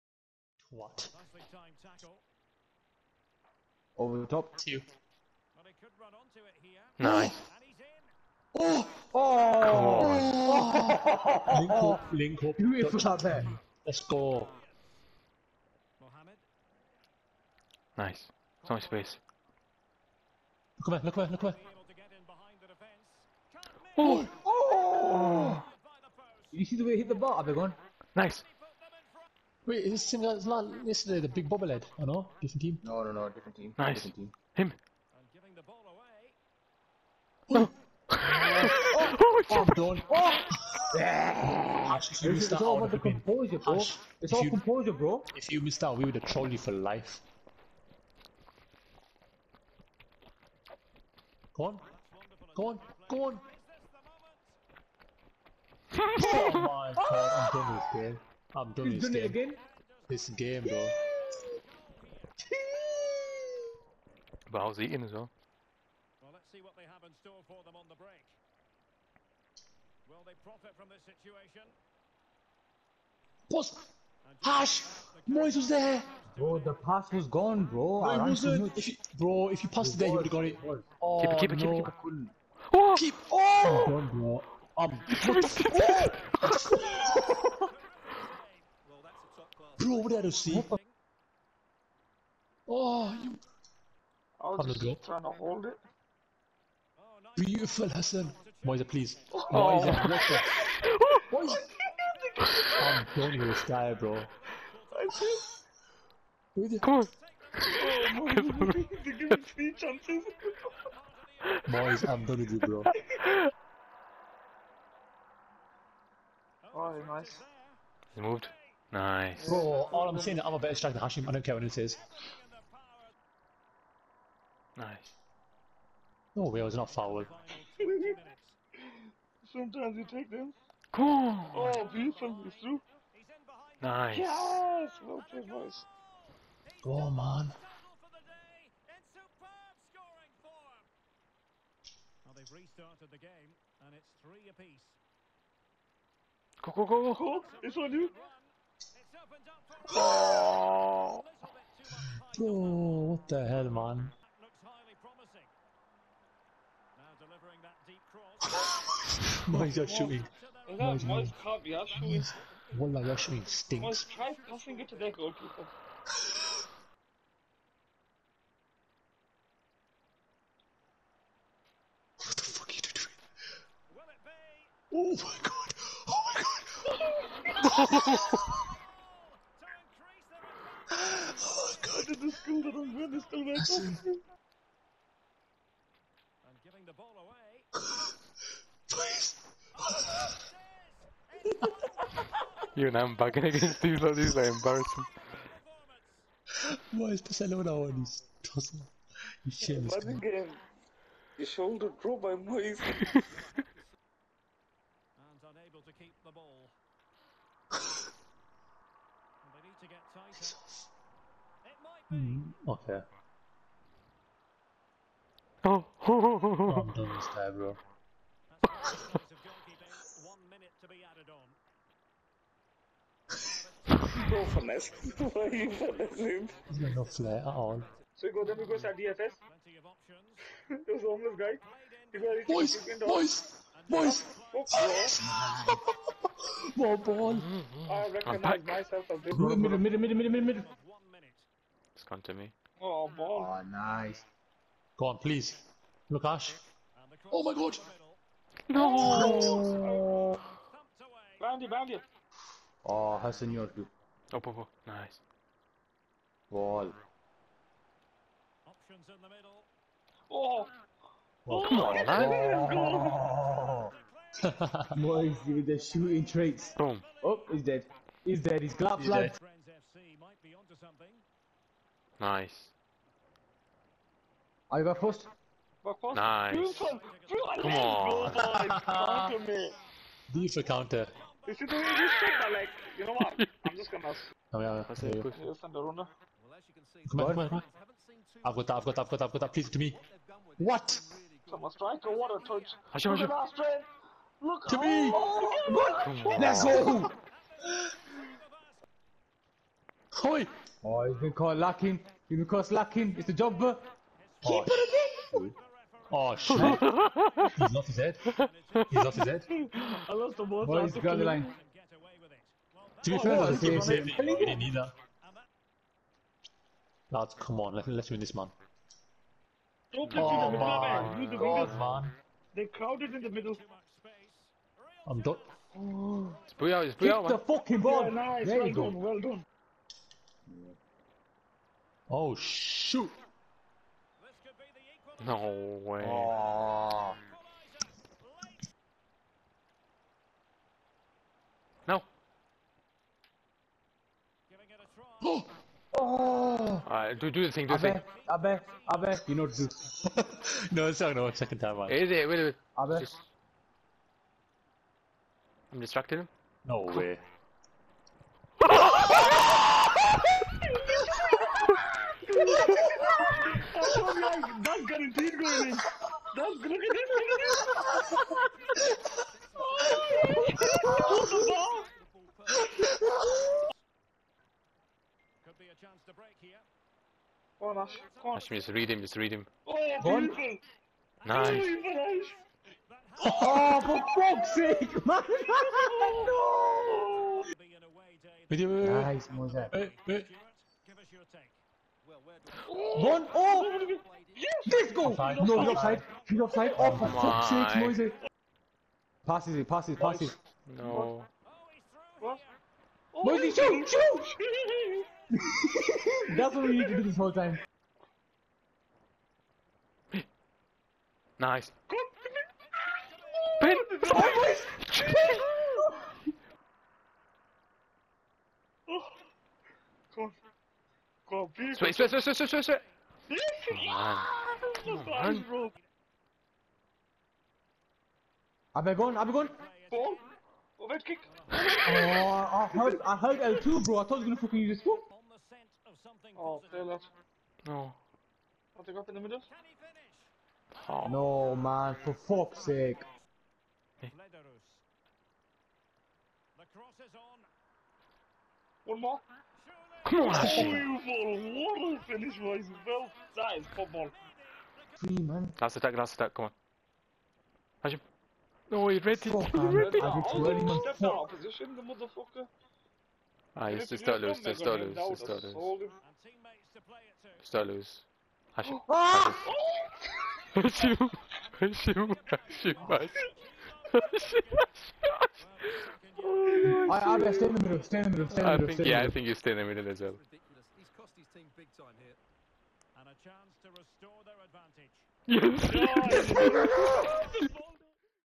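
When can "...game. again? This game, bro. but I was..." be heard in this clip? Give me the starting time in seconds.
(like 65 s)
59 s.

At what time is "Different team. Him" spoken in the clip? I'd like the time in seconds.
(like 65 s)
33 s.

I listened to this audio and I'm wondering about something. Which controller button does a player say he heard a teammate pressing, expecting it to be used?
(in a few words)
L2.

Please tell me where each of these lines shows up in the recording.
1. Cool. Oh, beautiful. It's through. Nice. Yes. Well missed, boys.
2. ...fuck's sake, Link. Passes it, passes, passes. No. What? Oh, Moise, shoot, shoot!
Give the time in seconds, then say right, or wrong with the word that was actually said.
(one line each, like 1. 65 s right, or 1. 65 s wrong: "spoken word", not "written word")
1. 130 s wrong: "played", not "missed"
2. 397 s wrong: "Moise", not "Link".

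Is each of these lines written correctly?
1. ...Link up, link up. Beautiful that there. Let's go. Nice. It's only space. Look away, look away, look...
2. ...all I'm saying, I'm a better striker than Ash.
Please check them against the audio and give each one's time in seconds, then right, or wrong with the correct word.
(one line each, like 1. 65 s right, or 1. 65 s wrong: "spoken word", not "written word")
1. 11 s right
2. 119 s wrong: "Hashim", not "Ash".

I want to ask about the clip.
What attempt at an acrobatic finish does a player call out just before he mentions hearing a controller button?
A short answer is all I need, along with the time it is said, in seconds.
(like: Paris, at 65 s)
Overhead kick, at 430 s.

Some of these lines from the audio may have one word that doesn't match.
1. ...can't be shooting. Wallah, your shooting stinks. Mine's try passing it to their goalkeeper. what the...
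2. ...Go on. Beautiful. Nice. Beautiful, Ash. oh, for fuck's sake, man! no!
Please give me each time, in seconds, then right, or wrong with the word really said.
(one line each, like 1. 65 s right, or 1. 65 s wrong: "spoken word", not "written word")
1. 161 s right
2. 380 s right.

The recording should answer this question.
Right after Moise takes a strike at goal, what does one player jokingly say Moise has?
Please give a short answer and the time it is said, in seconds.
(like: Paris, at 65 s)
shooting traits, at 265 s.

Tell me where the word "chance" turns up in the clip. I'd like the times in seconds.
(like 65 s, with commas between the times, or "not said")
109 s, 375 s, 483 s.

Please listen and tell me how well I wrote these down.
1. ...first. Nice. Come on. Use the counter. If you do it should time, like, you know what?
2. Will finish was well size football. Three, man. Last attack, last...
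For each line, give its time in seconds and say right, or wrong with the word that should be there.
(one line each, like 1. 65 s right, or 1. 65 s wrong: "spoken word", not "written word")
1. 275 s right
2. 450 s right.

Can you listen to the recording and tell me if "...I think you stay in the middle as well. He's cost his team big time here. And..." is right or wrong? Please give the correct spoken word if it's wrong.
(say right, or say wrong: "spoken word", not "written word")
right.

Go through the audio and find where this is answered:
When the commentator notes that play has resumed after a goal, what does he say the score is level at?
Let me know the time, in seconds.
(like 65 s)
144 s.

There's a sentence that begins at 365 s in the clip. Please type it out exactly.
That's look at this, look at this.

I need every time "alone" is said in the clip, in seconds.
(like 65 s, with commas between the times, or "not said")
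197 s.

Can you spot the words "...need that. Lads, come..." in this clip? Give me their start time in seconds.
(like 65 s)
314 s.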